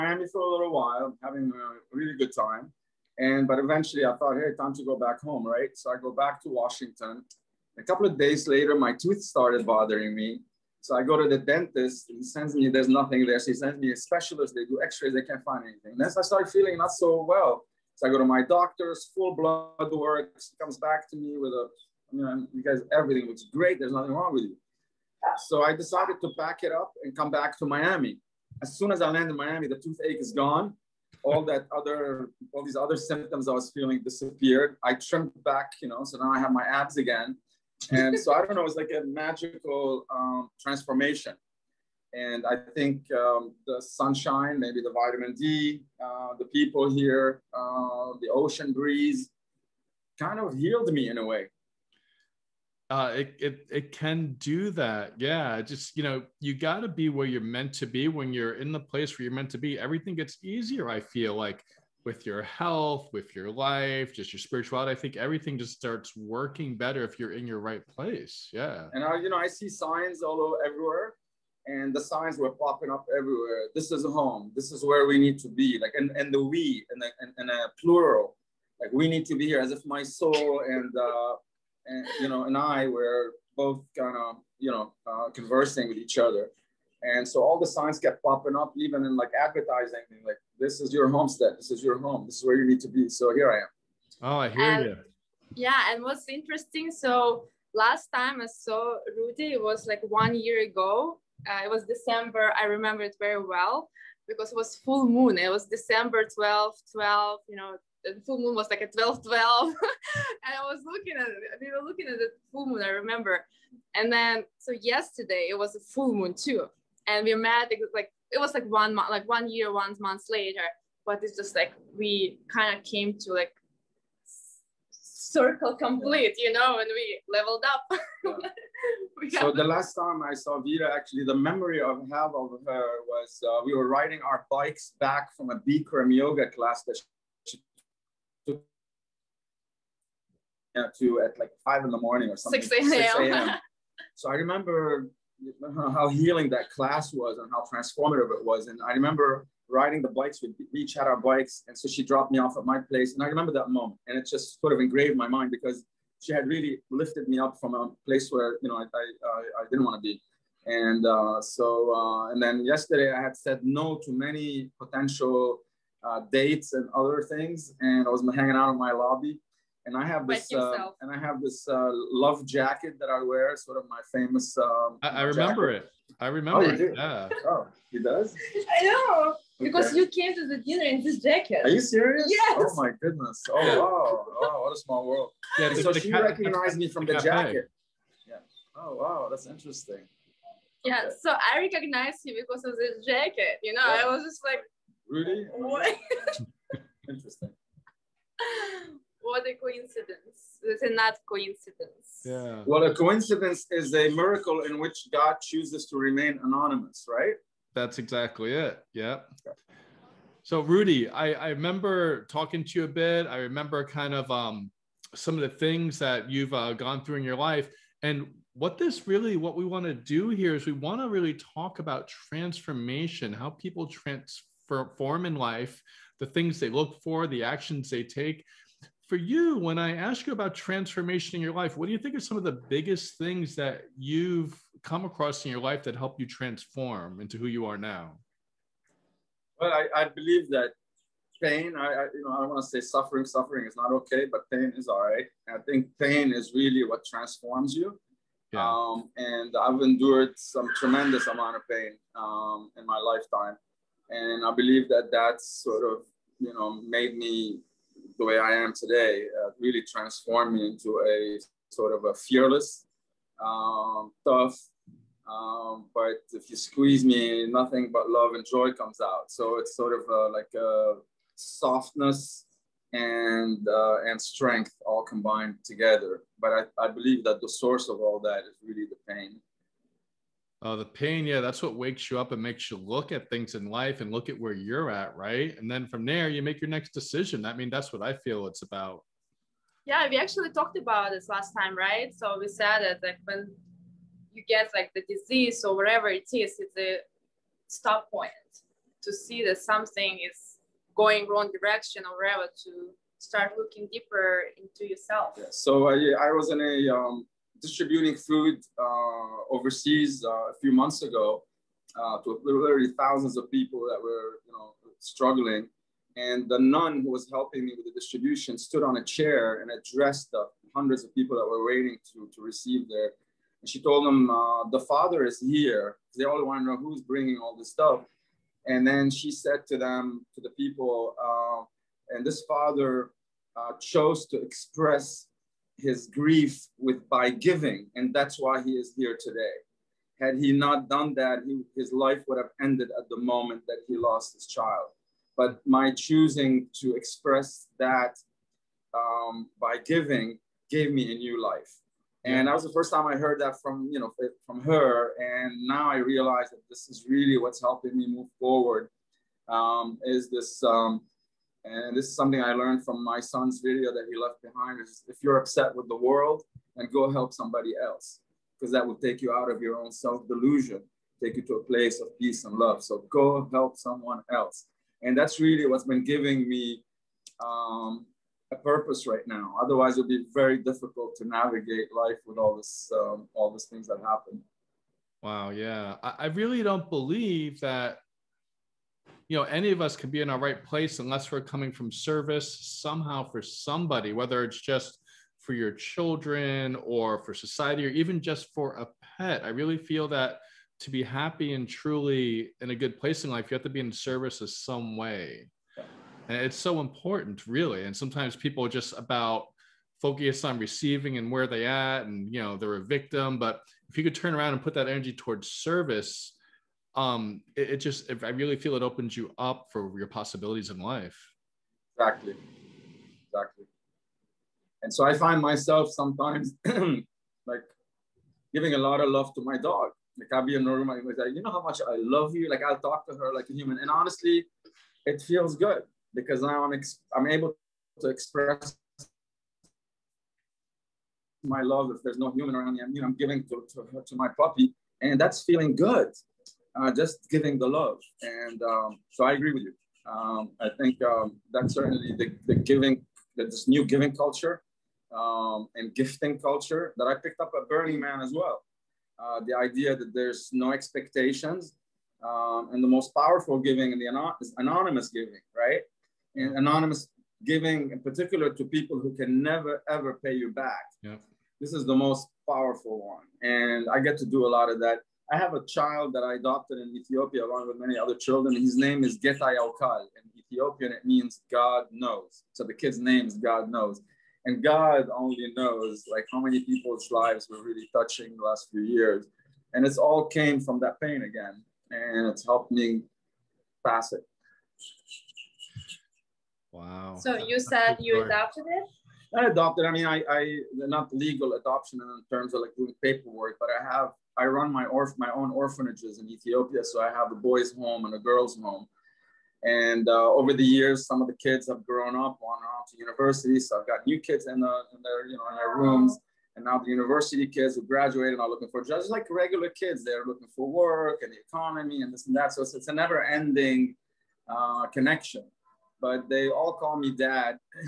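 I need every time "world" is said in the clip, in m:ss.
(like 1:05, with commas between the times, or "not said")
3:05, 6:05.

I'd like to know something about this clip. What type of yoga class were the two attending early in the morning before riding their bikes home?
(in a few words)
Bikram yoga.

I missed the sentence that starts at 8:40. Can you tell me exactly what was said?
They're looking for work and the economy and this and that.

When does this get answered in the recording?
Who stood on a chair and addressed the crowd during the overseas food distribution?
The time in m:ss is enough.
5:16.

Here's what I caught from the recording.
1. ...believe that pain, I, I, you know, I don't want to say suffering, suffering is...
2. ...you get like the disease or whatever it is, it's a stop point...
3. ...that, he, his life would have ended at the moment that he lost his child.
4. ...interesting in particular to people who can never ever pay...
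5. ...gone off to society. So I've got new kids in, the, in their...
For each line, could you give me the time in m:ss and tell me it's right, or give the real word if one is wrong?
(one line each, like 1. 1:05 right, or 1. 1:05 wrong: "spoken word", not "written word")
1. 4:00 right
2. 4:54 right
3. 5:41 right
4. 7:47 wrong: "giving", not "interesting"
5. 8:32 wrong: "university", not "society".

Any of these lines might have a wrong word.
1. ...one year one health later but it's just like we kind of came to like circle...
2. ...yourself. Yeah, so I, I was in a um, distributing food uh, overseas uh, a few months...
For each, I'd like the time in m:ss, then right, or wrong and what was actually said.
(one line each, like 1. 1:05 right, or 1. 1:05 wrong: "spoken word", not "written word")
1. 1:59 wrong: "month", not "health"
2. 5:04 right.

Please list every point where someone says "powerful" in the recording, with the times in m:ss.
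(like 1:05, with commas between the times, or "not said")
7:43, 7:52.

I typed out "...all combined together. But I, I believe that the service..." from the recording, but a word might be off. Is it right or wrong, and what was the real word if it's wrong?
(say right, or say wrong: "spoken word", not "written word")
wrong: "source", not "service".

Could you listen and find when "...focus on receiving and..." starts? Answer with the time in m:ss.
6:50.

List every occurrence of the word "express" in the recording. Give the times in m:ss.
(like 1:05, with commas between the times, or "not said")
5:34, 5:46, 7:18.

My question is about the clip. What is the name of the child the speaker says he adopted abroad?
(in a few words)
Getai Aukal.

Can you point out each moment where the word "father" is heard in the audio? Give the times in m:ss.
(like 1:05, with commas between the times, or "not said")
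5:24, 5:32.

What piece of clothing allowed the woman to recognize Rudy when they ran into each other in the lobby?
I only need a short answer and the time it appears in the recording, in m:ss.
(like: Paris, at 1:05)
love jacket, at 2:51.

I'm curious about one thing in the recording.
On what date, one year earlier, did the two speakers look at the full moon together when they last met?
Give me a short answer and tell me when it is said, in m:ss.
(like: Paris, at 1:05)
December 12, at 1:45.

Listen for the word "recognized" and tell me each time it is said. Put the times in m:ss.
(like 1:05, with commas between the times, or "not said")
3:06, 3:11.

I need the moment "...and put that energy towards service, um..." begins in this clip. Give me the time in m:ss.
6:54.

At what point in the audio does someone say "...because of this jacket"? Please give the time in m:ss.
3:12.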